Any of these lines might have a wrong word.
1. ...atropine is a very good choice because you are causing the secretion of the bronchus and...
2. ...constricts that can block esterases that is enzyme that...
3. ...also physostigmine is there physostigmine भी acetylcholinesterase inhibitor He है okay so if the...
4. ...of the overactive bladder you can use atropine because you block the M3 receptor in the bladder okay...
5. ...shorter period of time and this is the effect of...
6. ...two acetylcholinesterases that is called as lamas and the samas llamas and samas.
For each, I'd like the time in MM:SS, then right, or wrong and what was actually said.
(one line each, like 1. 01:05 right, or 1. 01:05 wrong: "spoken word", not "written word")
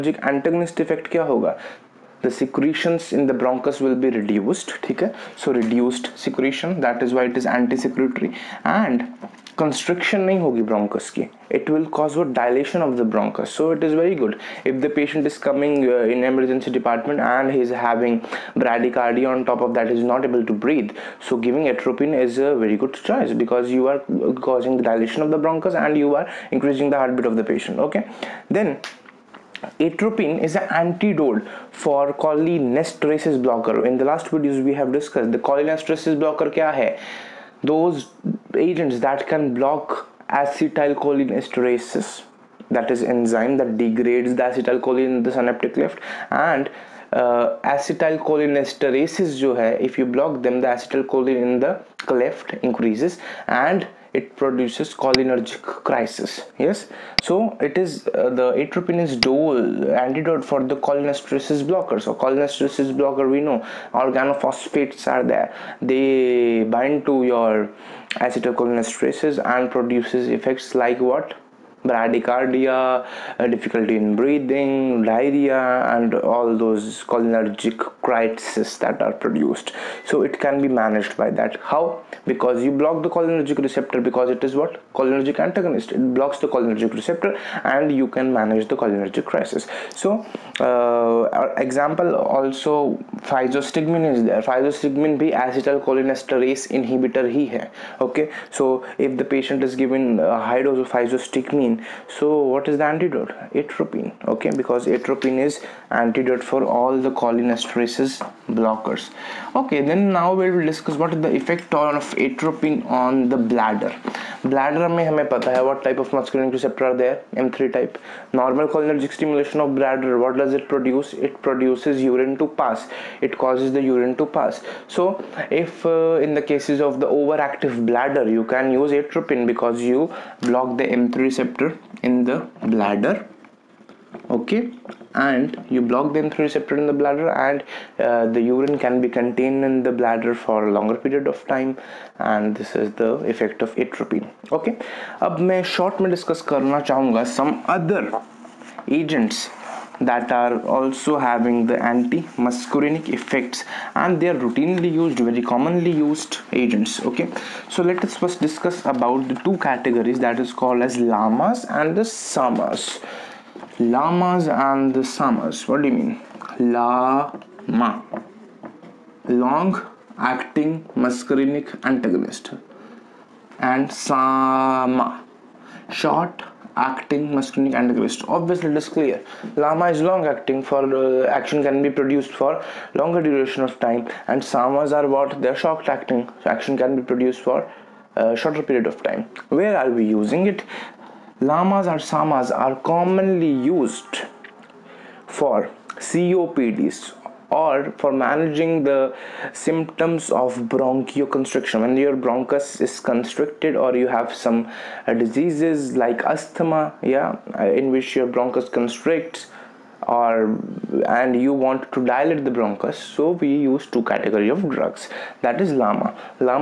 1. 00:21 wrong: "dilation", not "secretion"
2. 00:38 wrong: "agents", not "constricts"
3. 01:32 right
4. 02:06 right
5. 02:20 wrong: "longer", not "shorter"
6. 02:39 wrong: "categories", not "acetylcholinesterases".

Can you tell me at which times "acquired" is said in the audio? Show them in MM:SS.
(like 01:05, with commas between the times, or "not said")
not said.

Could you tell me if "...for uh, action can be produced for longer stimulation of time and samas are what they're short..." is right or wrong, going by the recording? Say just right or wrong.
wrong.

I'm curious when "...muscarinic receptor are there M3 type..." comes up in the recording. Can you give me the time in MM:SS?
01:56.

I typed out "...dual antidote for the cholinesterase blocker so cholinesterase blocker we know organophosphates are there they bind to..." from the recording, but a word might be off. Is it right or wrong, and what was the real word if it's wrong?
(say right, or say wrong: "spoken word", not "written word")
right.